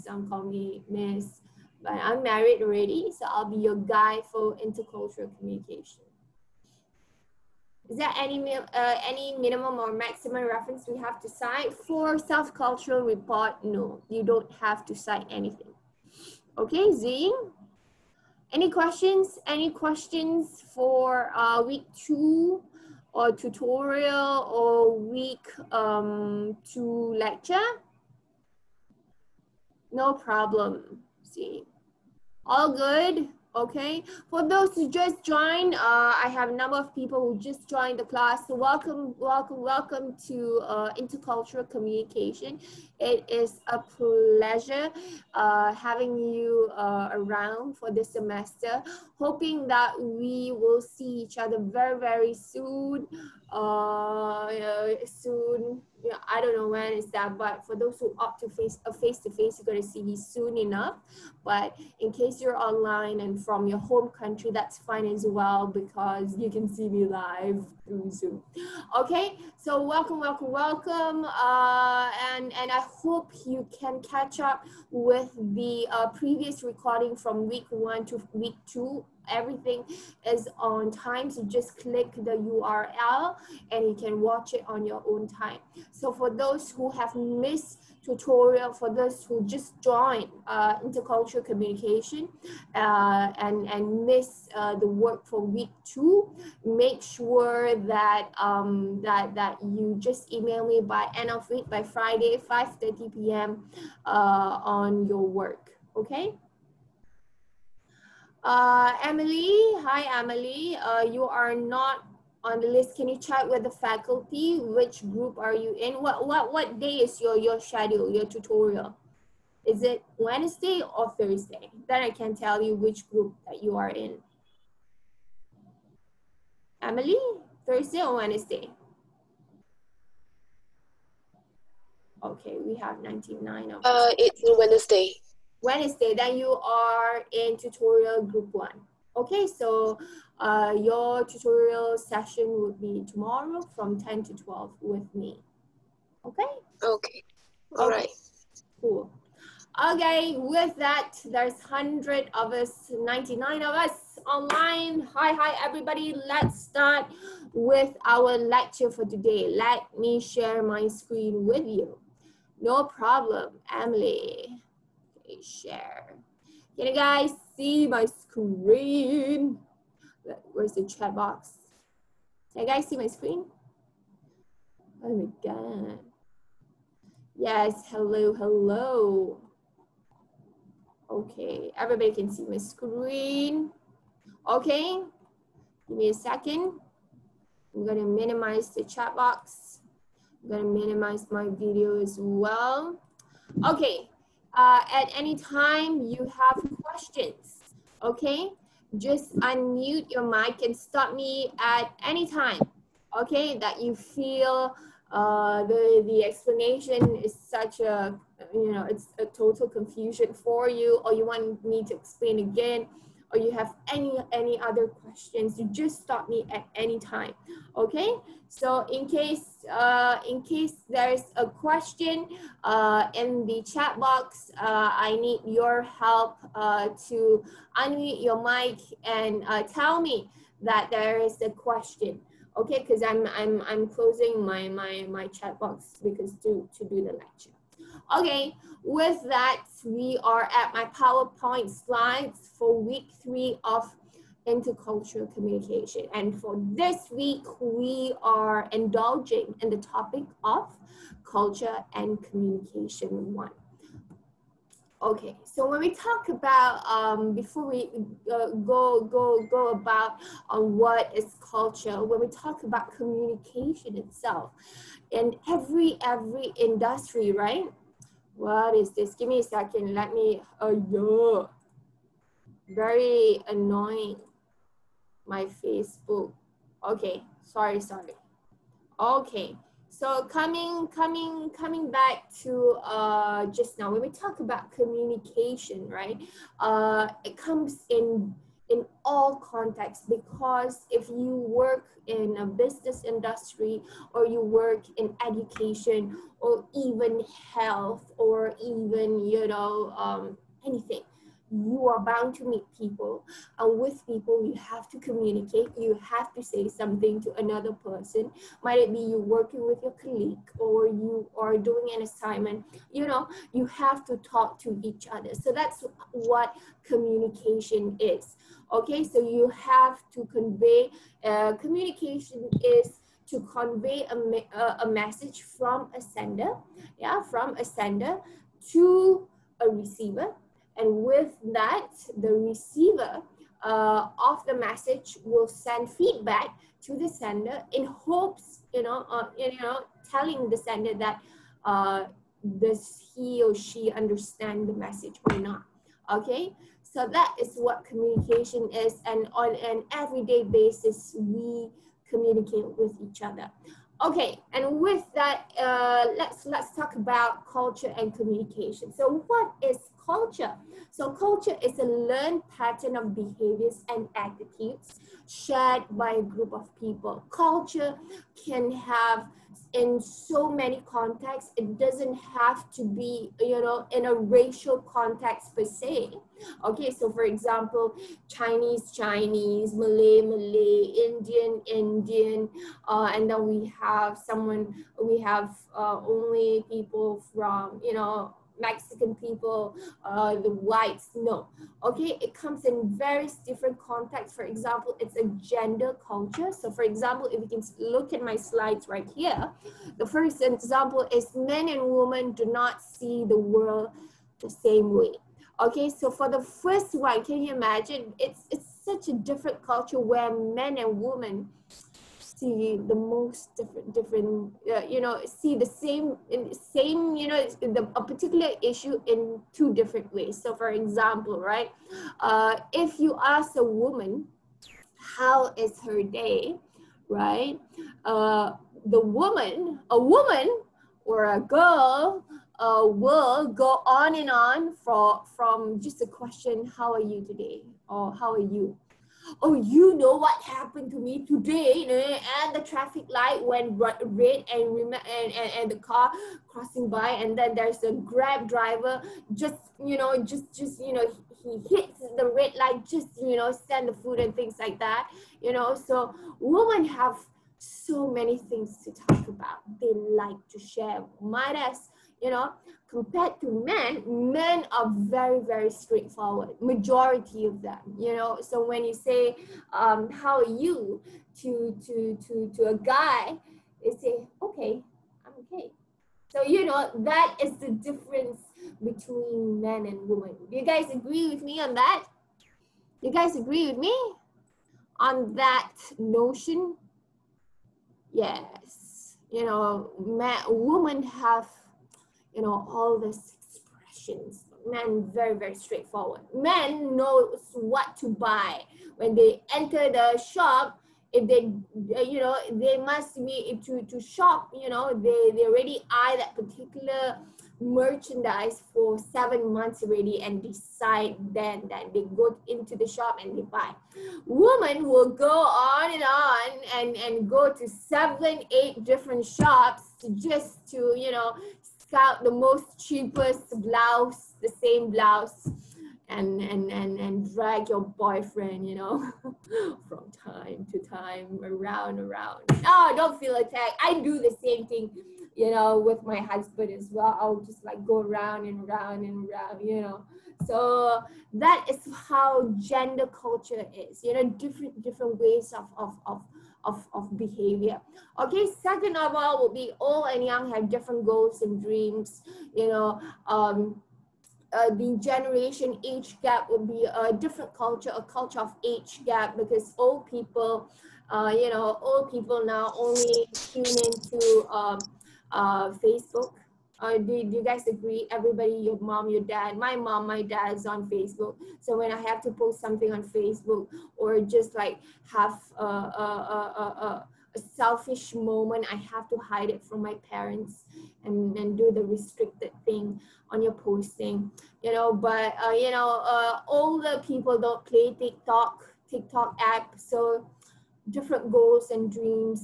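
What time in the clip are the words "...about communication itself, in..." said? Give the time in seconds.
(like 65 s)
262 s.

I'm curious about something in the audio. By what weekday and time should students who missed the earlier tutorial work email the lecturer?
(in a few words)
Friday, 5:30 p.m.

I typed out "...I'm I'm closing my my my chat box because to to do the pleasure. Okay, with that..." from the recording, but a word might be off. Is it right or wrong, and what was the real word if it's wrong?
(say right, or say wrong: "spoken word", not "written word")
wrong: "lecture", not "pleasure".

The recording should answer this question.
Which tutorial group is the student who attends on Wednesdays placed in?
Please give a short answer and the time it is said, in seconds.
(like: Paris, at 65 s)
tutorial group one, at 137 s.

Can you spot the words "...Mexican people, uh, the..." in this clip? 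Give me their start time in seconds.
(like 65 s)
388 s.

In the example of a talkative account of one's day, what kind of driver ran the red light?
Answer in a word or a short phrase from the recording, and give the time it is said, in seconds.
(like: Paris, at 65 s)
Grab driver, at 448 s.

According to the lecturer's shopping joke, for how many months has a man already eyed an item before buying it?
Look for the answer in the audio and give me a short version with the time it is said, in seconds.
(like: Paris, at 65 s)
7, at 508 s.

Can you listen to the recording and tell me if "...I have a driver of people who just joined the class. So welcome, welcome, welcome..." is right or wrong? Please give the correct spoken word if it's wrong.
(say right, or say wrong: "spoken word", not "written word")
wrong: "number", not "driver".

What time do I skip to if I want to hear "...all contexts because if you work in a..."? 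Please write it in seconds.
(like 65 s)
289 s.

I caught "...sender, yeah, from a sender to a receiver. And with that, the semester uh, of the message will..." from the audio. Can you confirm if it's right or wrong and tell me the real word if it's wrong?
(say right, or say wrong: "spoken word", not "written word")
wrong: "receiver", not "semester".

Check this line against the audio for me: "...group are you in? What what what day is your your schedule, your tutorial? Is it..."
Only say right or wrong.
right.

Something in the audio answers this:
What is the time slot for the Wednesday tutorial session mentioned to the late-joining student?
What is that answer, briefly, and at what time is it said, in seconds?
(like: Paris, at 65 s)
10 to 12, at 143 s.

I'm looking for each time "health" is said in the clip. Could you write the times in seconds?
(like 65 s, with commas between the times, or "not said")
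297 s.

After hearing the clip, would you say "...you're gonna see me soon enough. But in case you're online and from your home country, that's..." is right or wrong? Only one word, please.
right.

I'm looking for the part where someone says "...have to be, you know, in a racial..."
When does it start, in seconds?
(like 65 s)
372 s.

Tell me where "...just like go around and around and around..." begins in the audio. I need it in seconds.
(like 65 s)
537 s.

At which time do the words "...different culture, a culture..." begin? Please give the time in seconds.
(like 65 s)
557 s.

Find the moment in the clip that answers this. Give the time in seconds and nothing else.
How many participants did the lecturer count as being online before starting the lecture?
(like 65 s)
152 s.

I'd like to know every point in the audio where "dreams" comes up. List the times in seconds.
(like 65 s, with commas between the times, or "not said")
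551 s, 591 s.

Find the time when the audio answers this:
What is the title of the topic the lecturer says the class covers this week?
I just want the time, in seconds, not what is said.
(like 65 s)
251 s.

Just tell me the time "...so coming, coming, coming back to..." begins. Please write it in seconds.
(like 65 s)
279 s.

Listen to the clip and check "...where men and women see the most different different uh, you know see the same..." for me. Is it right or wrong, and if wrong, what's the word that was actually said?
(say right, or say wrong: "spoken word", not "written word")
right.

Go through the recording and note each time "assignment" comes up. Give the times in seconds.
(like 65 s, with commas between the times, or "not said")
312 s.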